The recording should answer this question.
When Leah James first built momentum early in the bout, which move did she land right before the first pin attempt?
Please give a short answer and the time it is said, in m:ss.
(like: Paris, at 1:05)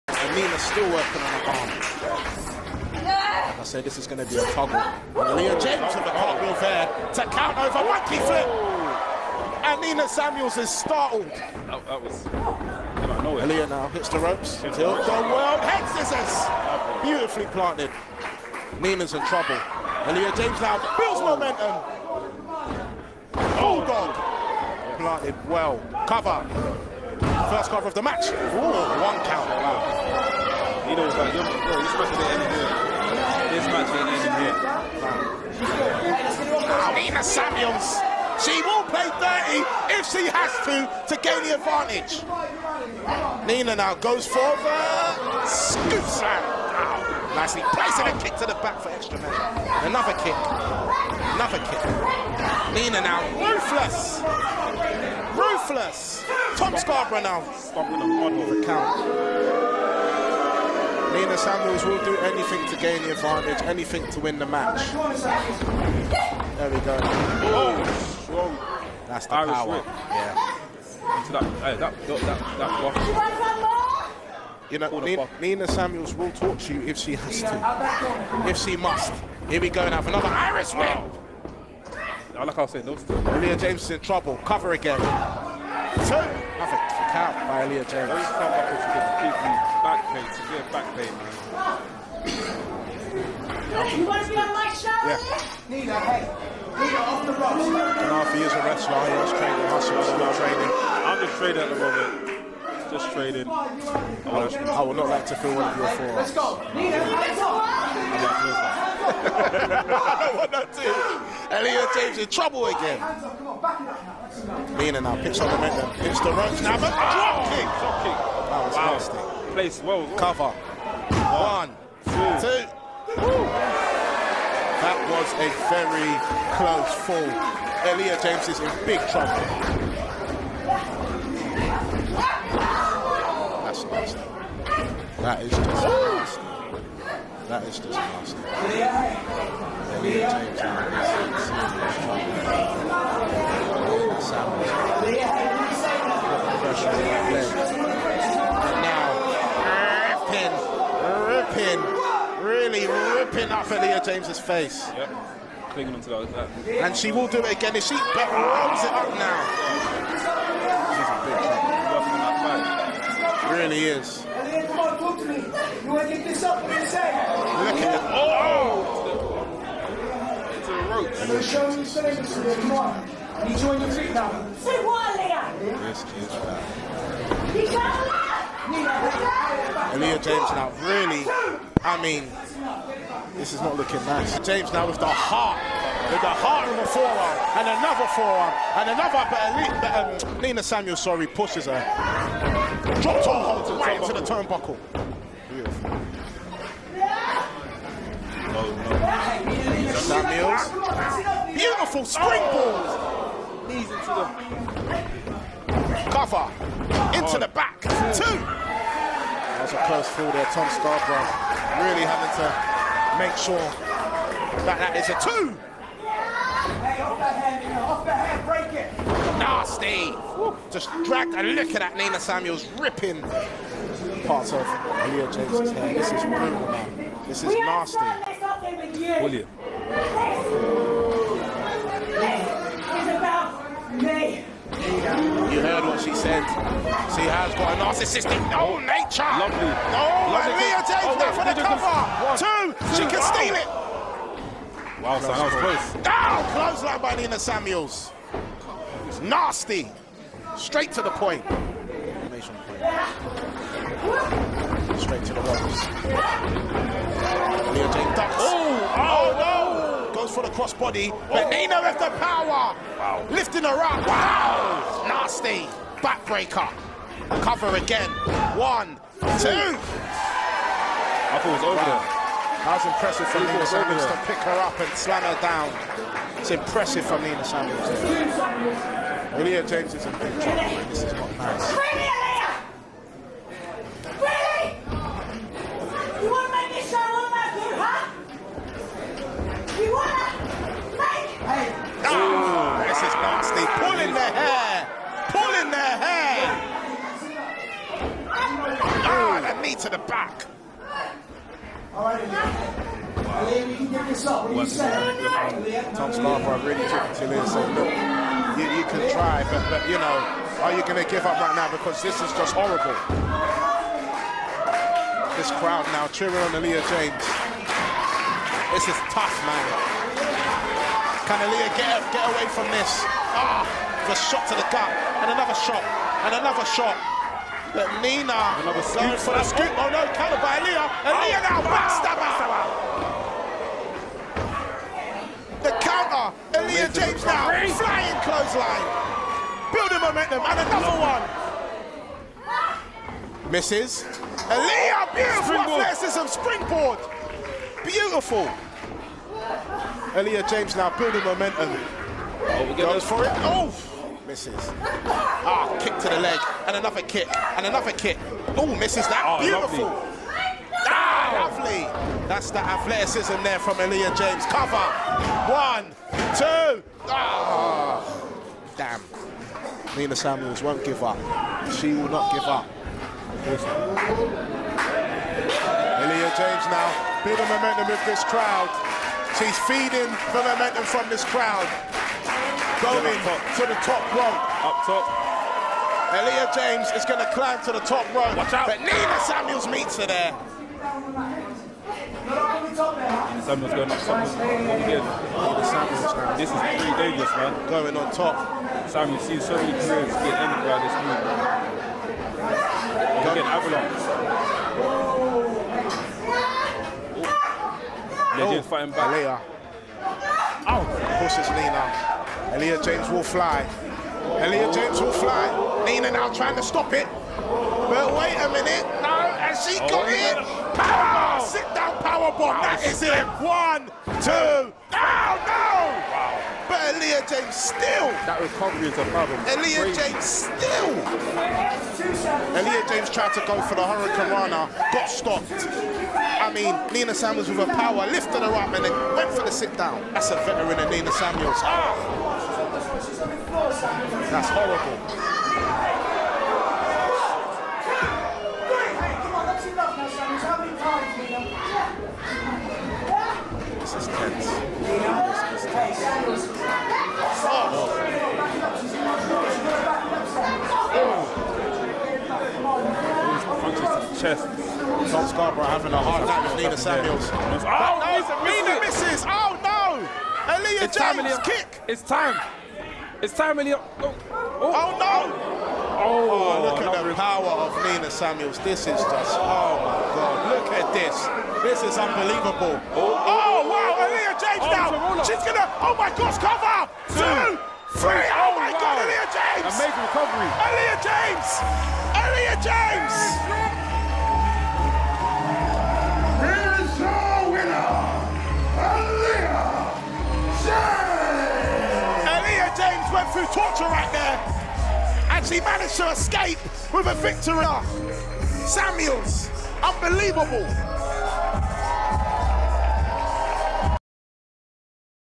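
Bulldog, at 0:23.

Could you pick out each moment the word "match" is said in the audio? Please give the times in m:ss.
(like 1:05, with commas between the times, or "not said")
0:28, 1:04.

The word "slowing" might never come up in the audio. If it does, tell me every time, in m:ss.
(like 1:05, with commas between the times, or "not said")
not said.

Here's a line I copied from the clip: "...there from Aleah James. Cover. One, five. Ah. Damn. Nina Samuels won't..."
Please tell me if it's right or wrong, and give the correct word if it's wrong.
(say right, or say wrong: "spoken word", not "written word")
wrong: "two", not "five".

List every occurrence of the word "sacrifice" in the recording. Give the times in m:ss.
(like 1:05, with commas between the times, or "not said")
not said.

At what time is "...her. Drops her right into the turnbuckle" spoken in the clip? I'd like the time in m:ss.
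3:11.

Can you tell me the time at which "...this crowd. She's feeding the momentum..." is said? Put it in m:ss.
6:18.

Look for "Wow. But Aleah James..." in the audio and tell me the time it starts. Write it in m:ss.
7:06.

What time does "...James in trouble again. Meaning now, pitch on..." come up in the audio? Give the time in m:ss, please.
1:51.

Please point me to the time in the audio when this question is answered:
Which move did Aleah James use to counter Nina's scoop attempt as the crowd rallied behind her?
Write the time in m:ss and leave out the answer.
5:31.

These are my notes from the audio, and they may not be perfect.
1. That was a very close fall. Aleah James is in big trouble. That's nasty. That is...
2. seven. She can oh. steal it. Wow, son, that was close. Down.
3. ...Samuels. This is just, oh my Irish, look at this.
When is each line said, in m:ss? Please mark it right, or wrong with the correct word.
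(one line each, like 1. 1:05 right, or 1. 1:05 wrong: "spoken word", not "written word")
1. 2:04 right
2. 4:02 wrong: "two", not "seven"
3. 7:58 wrong: "God", not "Irish".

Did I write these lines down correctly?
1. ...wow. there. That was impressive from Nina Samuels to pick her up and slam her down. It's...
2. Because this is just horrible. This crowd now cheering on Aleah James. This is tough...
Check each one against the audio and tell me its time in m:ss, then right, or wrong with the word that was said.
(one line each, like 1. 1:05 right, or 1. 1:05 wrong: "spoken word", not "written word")
1. 4:31 right
2. 5:11 right.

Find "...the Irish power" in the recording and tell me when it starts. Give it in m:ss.
1:09.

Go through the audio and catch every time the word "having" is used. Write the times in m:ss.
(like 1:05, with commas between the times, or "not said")
3:32, 7:45.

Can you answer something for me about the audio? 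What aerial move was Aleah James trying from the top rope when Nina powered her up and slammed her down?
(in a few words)
Hurricanrana.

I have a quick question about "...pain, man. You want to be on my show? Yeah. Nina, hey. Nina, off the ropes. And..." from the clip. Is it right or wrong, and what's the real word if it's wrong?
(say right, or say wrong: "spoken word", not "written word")
right.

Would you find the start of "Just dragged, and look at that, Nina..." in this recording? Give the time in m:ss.
3:40.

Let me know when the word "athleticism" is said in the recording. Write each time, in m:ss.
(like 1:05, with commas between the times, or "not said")
5:45, 6:02.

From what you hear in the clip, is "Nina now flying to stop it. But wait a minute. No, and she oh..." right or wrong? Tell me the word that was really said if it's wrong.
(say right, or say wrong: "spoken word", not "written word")
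wrong: "trying", not "flying".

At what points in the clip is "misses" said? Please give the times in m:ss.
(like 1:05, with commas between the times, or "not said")
5:43, 5:54, 5:58, 7:48.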